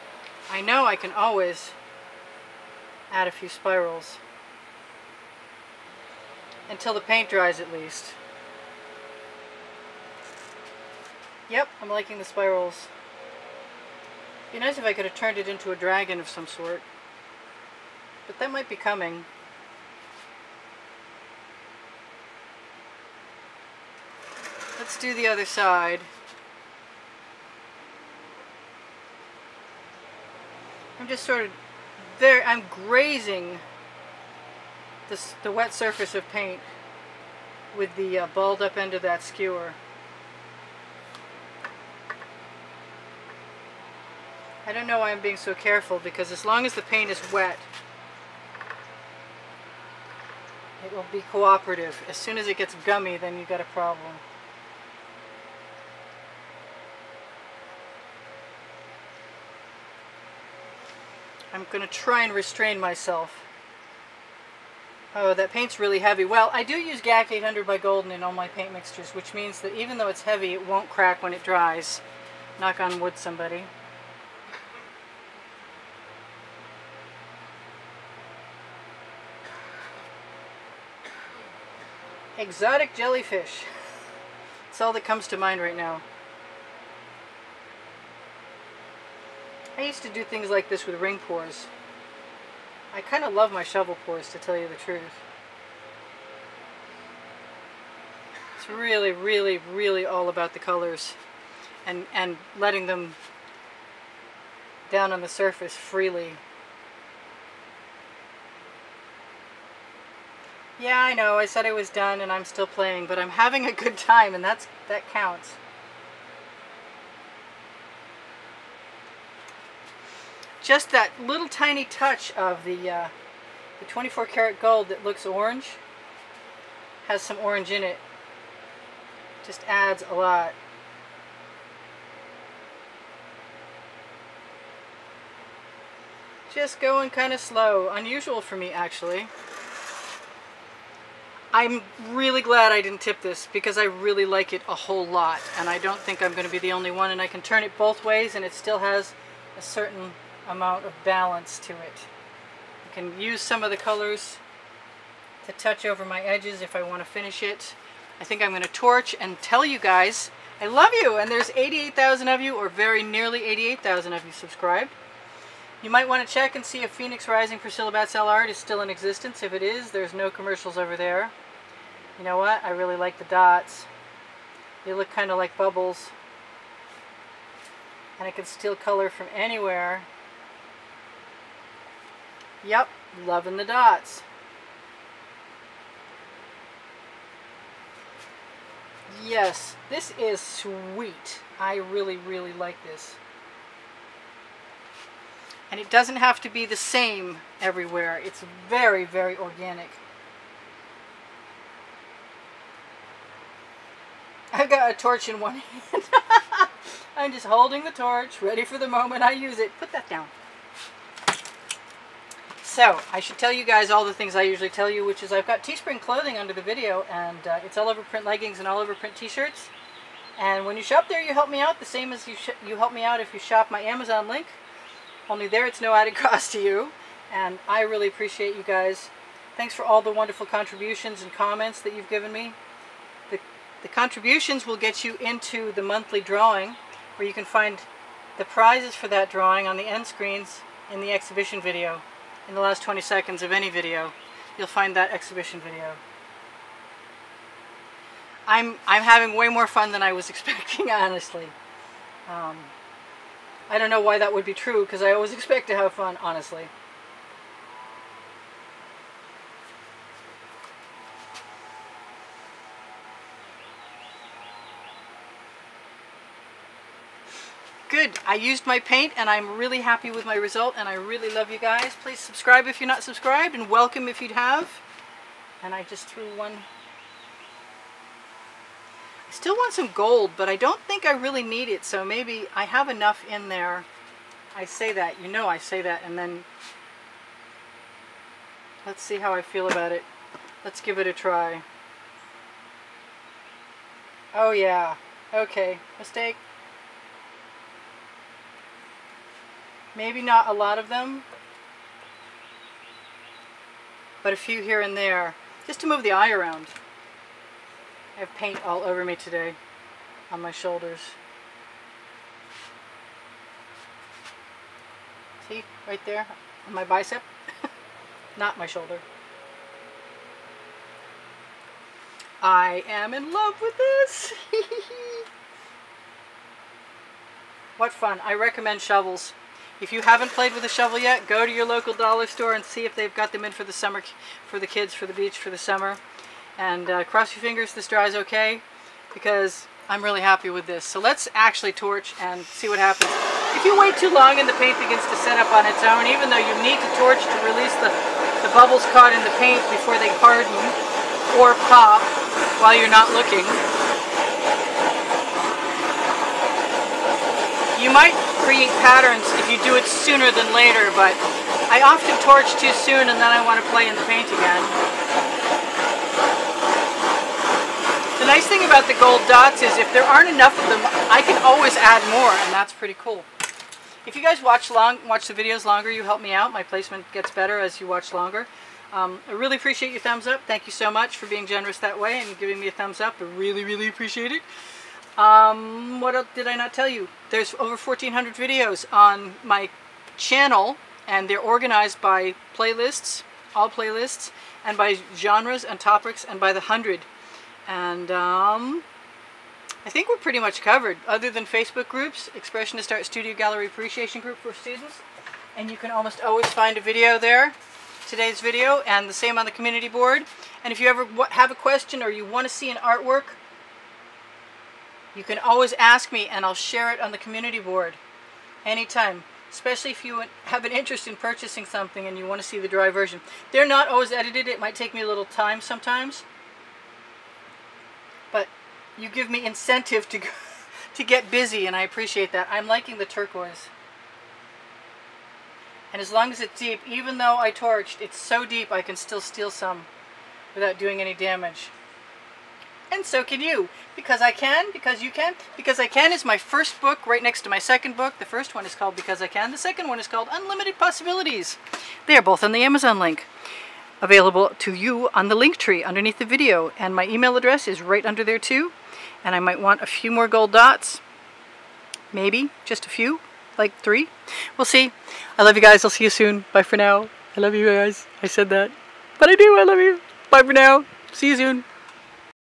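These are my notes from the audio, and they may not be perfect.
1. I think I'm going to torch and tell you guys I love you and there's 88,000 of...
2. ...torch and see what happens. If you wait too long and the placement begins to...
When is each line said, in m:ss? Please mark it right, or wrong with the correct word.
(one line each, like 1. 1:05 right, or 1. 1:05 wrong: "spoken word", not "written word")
1. 2:38 right
2. 5:41 wrong: "paint", not "placement".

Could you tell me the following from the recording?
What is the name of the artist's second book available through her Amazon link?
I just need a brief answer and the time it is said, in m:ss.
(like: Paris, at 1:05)
Unlimited Possibilities, at 7:30.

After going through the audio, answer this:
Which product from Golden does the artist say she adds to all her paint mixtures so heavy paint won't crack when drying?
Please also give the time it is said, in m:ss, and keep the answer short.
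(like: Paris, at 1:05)
GAC 800, at 1:07.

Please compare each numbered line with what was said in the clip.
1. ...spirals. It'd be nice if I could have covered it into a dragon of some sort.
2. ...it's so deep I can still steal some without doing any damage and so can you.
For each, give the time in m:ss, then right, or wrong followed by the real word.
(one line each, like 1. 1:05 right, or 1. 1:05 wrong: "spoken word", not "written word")
1. 0:12 wrong: "turned", not "covered"
2. 7:17 right.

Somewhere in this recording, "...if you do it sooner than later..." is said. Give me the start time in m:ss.
5:59.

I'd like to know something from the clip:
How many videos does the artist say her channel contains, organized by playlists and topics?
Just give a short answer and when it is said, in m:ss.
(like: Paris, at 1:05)
over 1,400, at 6:27.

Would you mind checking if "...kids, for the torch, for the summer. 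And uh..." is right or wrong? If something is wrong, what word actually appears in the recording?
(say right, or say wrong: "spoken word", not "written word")
wrong: "beach", not "torch".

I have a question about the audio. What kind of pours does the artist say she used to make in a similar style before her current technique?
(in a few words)
ring pours.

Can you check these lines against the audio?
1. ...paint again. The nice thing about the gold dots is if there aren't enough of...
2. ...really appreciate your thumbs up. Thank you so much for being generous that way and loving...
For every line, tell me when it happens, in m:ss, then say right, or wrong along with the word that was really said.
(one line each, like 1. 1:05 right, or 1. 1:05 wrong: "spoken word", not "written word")
1. 6:04 right
2. 6:19 wrong: "giving", not "loving".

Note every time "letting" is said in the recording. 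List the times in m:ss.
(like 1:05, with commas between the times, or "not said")
1:42.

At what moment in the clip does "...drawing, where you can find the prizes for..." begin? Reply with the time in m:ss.
3:56.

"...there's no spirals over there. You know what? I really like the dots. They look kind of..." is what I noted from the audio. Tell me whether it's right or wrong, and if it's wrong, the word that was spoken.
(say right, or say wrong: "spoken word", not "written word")
wrong: "commercials", not "spirals".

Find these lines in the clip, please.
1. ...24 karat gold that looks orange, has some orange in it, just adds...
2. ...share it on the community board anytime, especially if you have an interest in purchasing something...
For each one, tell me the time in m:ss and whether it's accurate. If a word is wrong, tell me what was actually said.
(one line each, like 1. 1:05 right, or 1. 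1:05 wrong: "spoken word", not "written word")
1. 2:03 right
2. 6:56 right.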